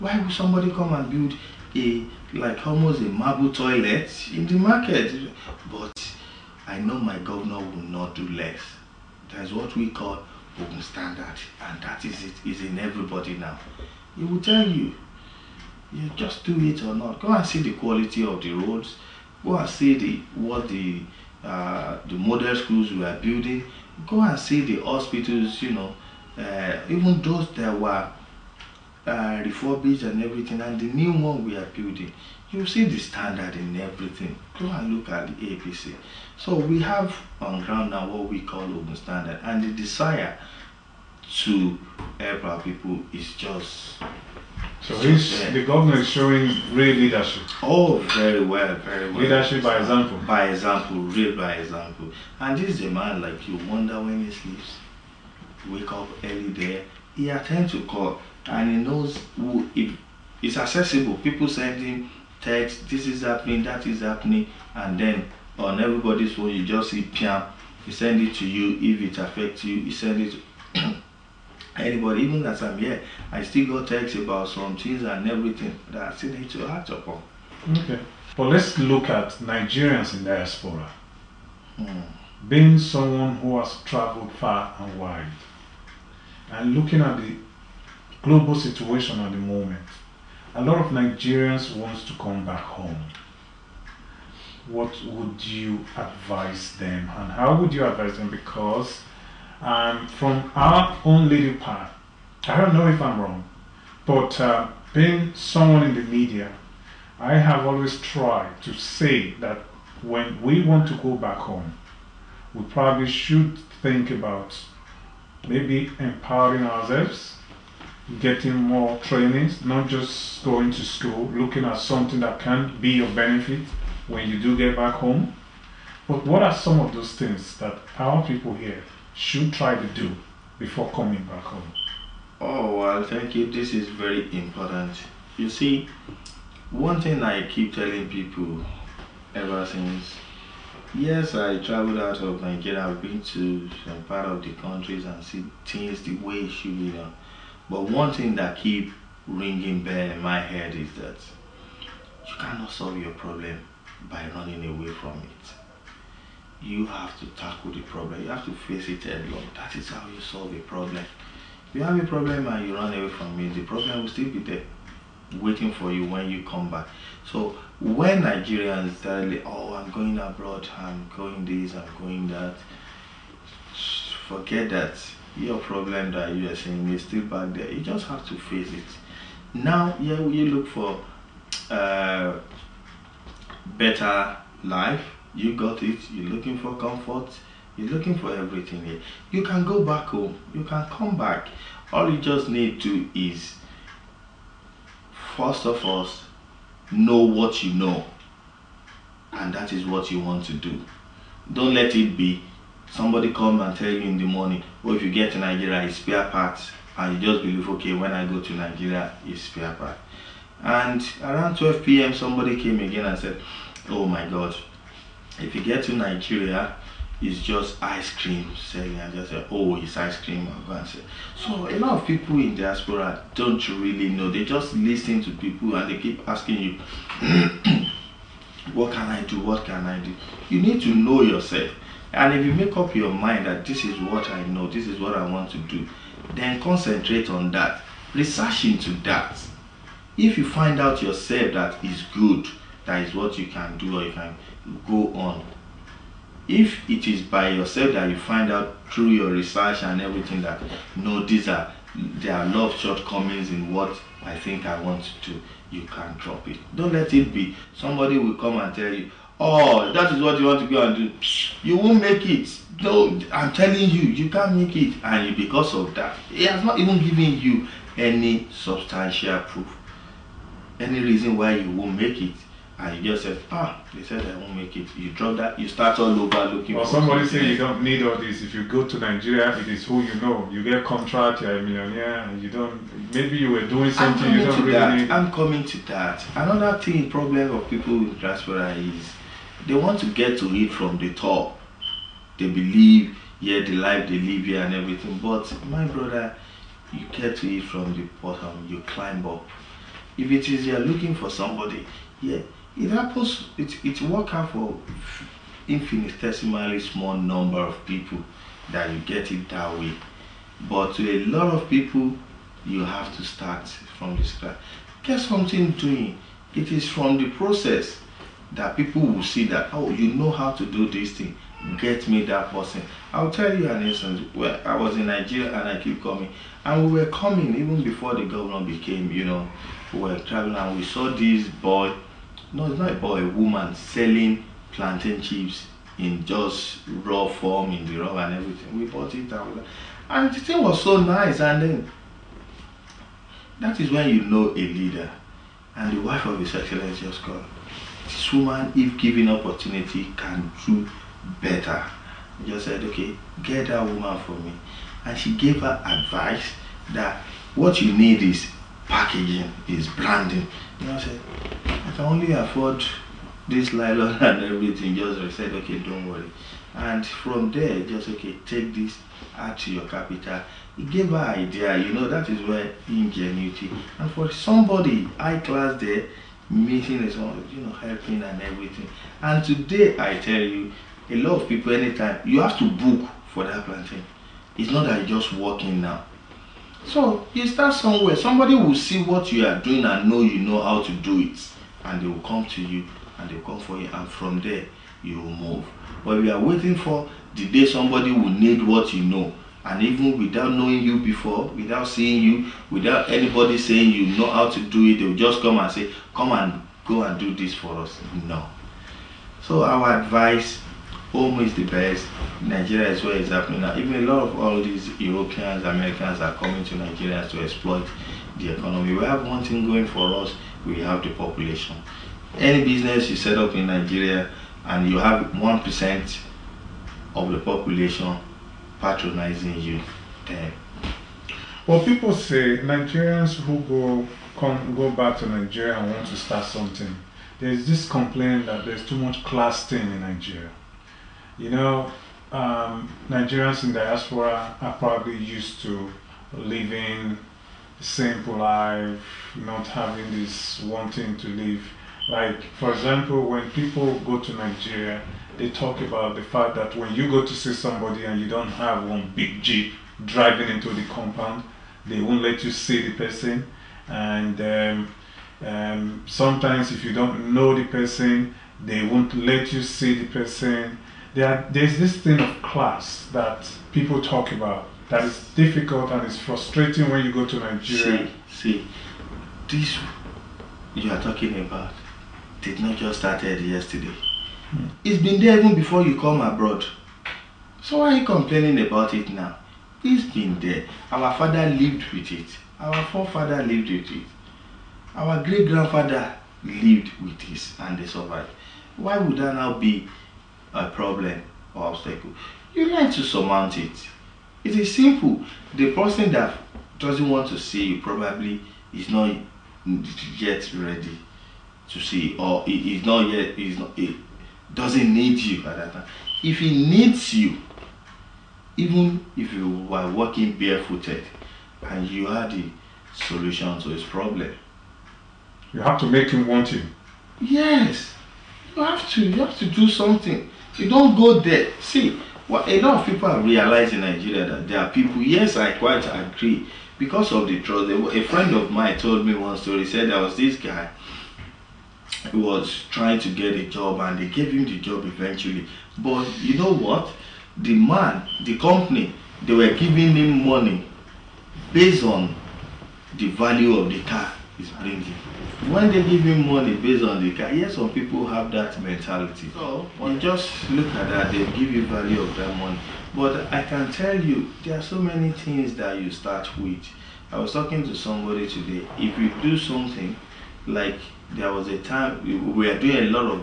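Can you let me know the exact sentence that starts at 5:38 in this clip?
We bought it and, we, and the thing was so nice.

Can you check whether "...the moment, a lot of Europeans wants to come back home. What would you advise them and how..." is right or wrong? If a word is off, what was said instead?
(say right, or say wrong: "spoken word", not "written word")
wrong: "Nigerians", not "Europeans".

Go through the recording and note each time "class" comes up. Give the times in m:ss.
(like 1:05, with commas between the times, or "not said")
6:15, 7:19, 7:52.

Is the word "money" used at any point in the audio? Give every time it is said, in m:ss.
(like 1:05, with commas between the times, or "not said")
9:10, 9:16, 9:22.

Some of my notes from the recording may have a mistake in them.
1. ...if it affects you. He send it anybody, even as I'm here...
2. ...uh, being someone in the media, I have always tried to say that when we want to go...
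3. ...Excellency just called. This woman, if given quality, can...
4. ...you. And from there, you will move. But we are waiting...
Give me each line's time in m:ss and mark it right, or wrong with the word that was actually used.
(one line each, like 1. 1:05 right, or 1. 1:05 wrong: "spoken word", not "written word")
1. 1:08 right
2. 1:44 right
3. 5:46 wrong: "opportunity", not "quality"
4. 6:33 right.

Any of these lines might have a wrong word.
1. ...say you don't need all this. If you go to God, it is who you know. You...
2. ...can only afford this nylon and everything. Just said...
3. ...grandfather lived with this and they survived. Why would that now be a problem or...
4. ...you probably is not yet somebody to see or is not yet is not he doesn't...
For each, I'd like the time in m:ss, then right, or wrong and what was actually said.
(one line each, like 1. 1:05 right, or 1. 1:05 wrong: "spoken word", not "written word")
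1. 4:37 wrong: "Nigeria", not "God"
2. 6:01 right
3. 8:15 right
4. 8:27 wrong: "ready", not "somebody".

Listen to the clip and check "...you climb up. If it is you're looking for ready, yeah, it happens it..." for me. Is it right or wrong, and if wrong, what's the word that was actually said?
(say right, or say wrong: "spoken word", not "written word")
wrong: "somebody", not "ready".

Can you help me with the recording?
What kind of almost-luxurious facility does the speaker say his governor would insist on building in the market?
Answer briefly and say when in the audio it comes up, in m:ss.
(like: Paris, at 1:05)
marble toilet, at 0:03.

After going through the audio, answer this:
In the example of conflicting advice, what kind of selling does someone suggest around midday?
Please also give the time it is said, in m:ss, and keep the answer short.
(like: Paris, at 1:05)
ice cream selling, at 3:37.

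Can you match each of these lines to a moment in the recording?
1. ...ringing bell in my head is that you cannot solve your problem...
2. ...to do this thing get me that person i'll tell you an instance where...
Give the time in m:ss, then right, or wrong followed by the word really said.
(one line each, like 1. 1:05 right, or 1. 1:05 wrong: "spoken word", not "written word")
1. 2:29 right
2. 5:20 right.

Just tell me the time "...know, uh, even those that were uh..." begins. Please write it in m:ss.
0:25.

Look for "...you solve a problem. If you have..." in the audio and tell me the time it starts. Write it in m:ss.
2:40.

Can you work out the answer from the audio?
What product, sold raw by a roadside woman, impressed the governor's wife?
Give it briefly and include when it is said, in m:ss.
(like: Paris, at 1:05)
plantain chips, at 5:34.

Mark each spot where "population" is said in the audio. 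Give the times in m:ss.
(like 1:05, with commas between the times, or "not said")
7:01, 7:07.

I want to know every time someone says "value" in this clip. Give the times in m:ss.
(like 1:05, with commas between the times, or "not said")
9:13, 9:21.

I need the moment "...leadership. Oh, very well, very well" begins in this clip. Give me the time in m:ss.
0:46.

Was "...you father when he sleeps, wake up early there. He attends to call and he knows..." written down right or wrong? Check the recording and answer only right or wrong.
wrong.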